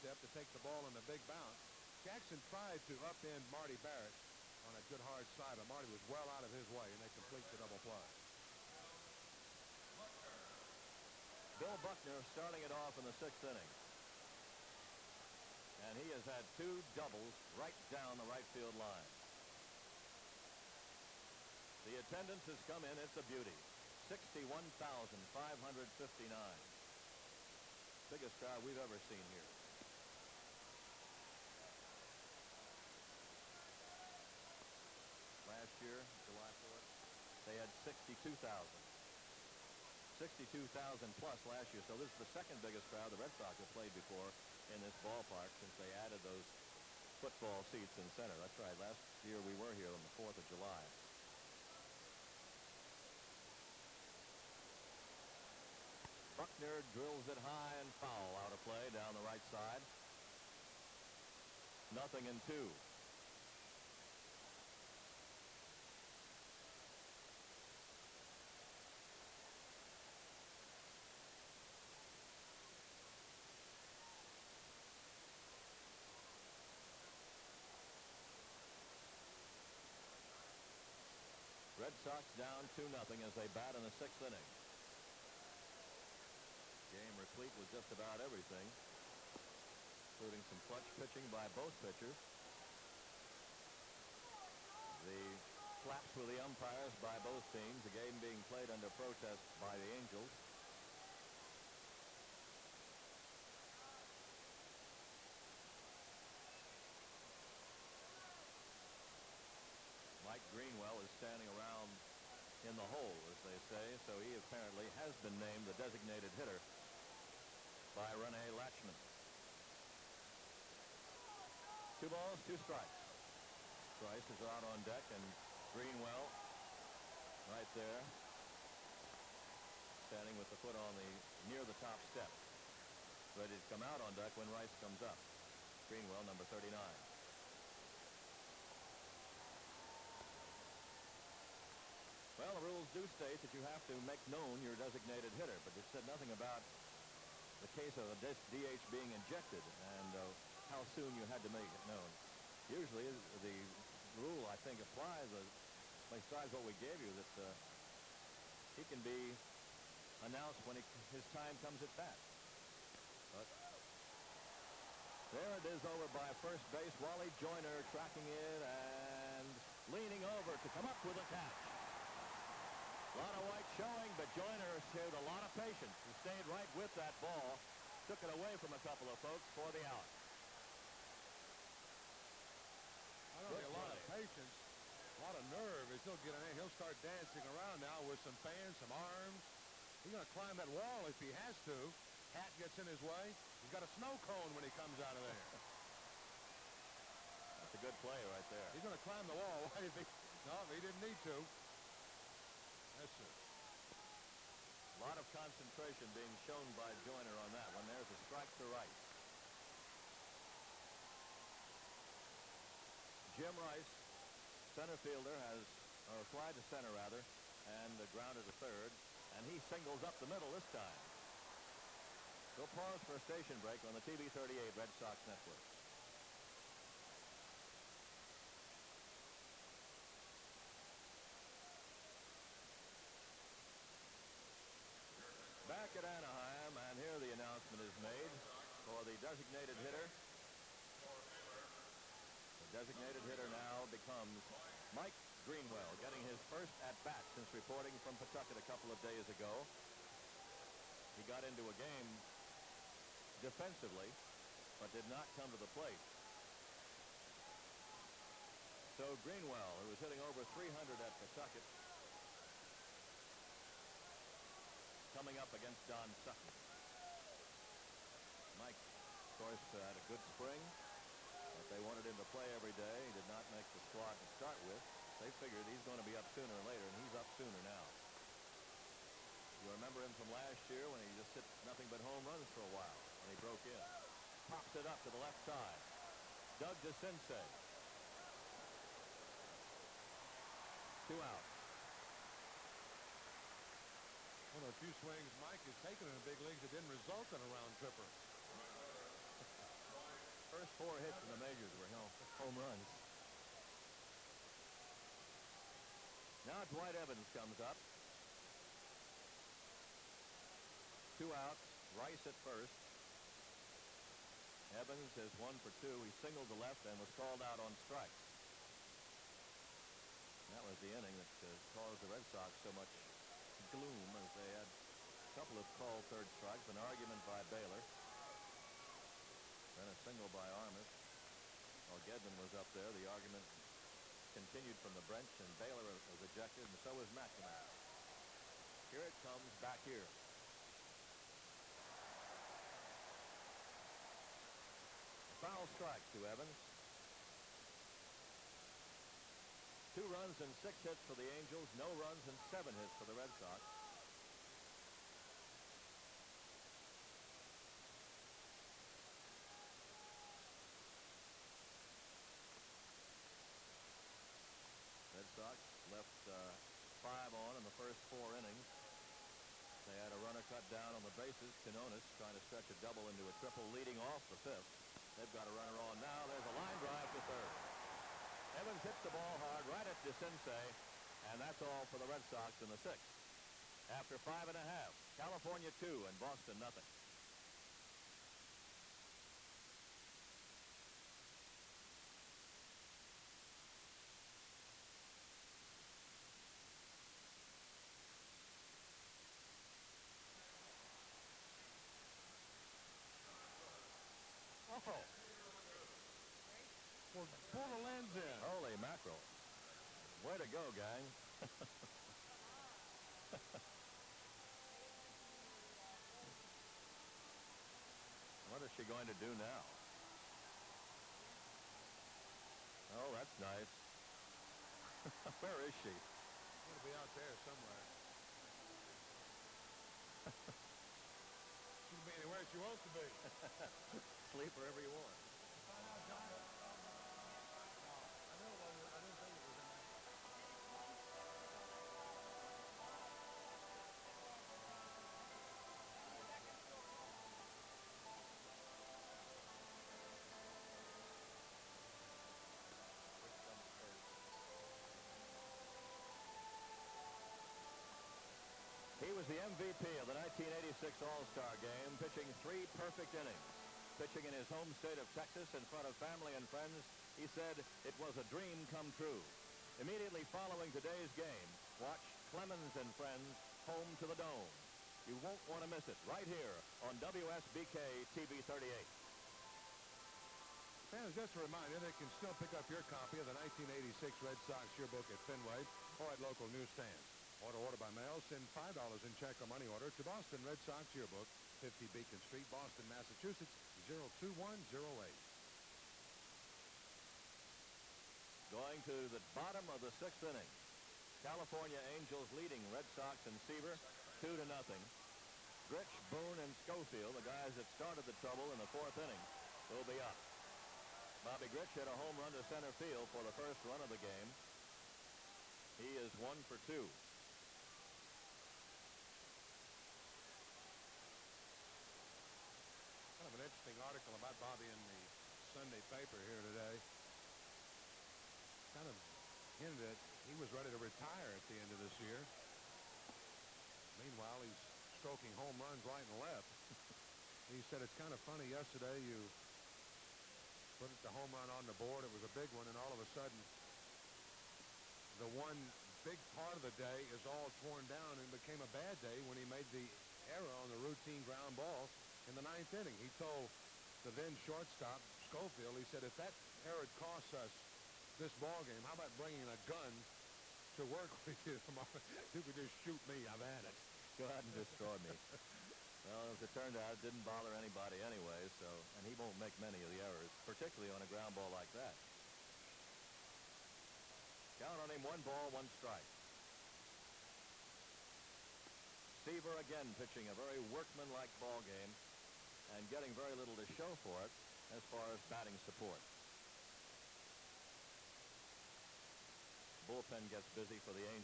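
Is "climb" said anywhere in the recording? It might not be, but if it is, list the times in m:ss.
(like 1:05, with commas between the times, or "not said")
3:10, 3:19.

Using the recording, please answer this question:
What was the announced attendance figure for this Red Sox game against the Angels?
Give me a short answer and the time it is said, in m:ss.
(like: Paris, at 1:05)
61,559, at 0:24.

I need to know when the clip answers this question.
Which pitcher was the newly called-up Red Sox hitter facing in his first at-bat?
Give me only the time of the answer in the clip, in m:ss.
4:25.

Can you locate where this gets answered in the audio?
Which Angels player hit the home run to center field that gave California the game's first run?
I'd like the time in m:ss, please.
8:31.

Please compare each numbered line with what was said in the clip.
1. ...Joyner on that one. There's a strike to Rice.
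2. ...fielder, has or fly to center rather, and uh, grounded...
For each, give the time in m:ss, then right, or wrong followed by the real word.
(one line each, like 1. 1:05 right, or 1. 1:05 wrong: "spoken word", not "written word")
1. 3:27 right
2. 3:35 right.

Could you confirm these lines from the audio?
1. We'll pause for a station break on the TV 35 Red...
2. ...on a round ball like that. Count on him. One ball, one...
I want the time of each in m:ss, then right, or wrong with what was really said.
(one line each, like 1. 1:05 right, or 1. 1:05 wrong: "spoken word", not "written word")
1. 3:42 wrong: "38", not "35"
2. 9:30 wrong: "ground", not "round".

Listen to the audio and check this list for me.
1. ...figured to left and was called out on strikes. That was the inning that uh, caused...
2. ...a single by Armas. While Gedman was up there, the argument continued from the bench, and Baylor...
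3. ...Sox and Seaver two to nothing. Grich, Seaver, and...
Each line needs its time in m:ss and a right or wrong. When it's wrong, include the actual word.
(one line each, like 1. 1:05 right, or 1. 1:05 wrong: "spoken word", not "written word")
1. 5:16 wrong: "singled", not "figured"
2. 5:29 right
3. 8:22 wrong: "Boone", not "Seaver".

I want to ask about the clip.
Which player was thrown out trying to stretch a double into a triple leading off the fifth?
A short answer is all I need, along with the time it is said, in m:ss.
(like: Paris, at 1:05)
Quiñones, at 6:11.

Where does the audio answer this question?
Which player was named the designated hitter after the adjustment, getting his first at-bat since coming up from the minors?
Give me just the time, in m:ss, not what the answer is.
4:04.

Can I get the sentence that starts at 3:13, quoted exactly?
He's got a snow cone when he comes out of there.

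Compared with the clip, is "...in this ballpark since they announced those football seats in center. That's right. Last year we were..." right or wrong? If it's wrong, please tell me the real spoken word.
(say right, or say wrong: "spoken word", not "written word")
wrong: "added", not "announced".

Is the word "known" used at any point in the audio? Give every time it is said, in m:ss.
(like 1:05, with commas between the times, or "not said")
2:24, 2:31.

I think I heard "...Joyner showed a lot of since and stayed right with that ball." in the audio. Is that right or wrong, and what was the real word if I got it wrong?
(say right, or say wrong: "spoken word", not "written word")
wrong: "patience", not "since".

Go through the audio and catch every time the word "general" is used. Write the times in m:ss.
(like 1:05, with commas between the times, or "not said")
not said.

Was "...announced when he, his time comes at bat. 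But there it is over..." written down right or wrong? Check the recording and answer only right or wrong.
right.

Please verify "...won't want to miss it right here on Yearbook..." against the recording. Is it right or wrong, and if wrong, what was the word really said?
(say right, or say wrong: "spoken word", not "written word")
wrong: "WSBK", not "Yearbook".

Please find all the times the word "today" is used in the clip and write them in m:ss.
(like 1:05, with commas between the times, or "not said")
7:50, 8:46.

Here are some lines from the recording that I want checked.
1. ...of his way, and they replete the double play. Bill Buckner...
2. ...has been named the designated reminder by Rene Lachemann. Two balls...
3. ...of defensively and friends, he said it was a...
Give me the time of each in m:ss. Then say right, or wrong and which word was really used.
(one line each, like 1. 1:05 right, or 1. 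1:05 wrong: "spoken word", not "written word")
1. 0:06 wrong: "complete", not "replete"
2. 1:54 wrong: "hitter", not "reminder"
3. 7:45 wrong: "family", not "defensively".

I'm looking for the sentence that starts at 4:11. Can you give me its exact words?
He got into a game defensively, but did not come to the plate.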